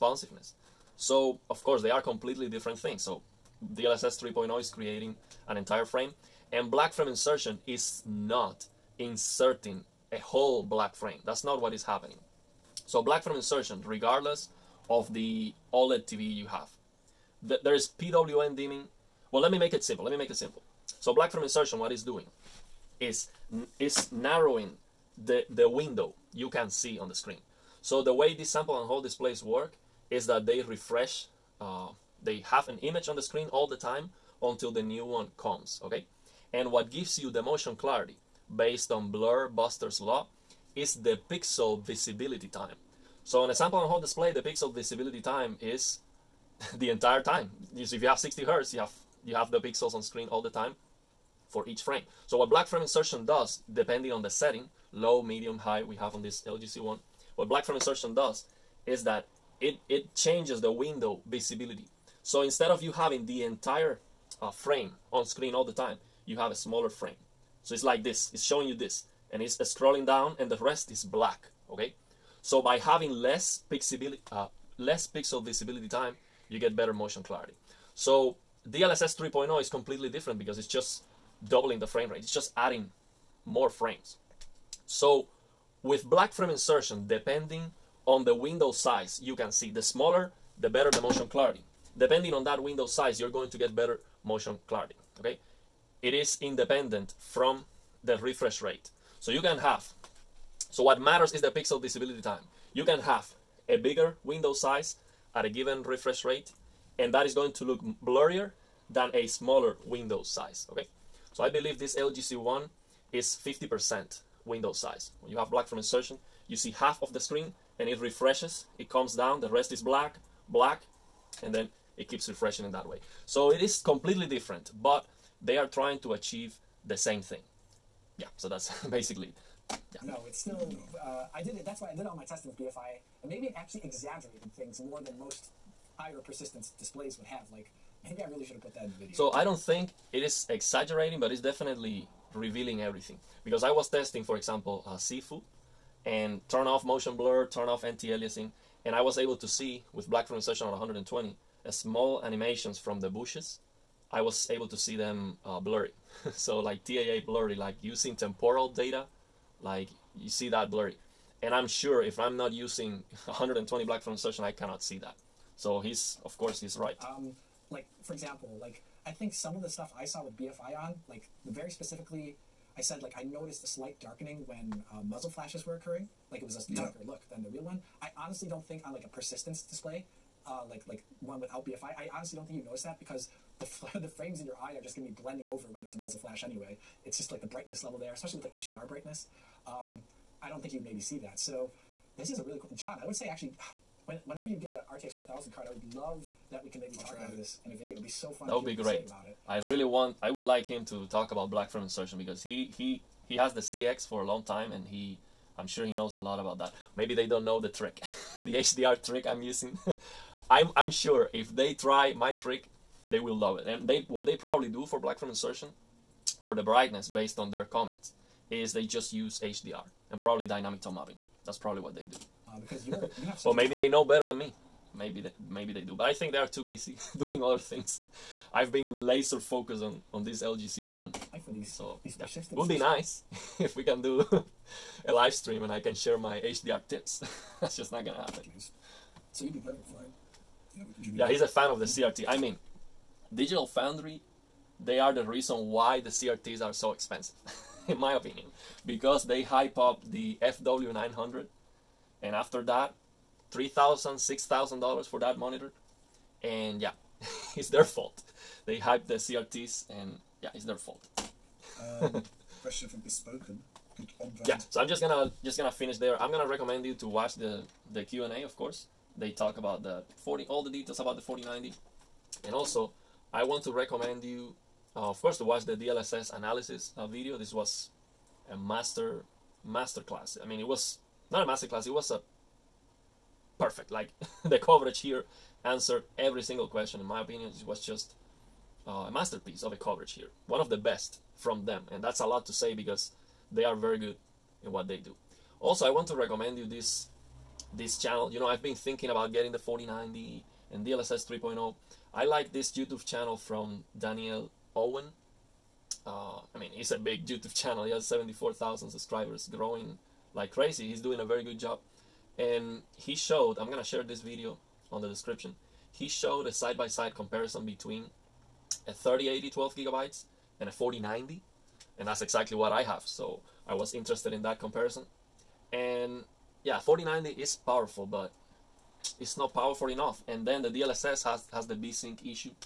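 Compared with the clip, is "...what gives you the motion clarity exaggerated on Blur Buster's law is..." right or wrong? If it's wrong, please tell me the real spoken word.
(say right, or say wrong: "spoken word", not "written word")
wrong: "based", not "exaggerated".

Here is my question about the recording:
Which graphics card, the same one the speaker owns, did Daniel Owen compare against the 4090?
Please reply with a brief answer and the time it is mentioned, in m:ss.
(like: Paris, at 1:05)
3080 12GB, at 5:18.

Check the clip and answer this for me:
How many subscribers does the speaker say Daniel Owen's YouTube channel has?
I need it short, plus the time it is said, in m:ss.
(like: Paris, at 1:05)
74,000, at 5:08.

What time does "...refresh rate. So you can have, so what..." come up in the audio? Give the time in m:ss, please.
1:38.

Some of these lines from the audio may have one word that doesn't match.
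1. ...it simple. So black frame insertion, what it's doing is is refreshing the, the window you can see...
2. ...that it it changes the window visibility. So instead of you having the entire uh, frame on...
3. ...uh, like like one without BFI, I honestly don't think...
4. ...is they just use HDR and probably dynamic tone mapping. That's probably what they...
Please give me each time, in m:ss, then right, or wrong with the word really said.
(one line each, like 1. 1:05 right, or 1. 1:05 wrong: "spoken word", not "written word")
1. 0:20 wrong: "narrowing", not "refreshing"
2. 0:59 right
3. 3:00 right
4. 3:38 right.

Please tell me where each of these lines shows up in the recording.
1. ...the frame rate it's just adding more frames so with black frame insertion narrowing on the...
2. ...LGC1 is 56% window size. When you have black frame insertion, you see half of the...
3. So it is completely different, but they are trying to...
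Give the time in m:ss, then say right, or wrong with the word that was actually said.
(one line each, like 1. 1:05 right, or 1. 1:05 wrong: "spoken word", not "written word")
1. 1:21 wrong: "depending", not "narrowing"
2. 1:51 wrong: "50", not "56"
3. 2:03 right.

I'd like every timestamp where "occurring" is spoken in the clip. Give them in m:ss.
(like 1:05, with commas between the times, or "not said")
2:55.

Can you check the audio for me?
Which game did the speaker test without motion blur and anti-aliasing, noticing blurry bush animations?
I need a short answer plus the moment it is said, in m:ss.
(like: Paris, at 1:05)
Sifu, at 2:24.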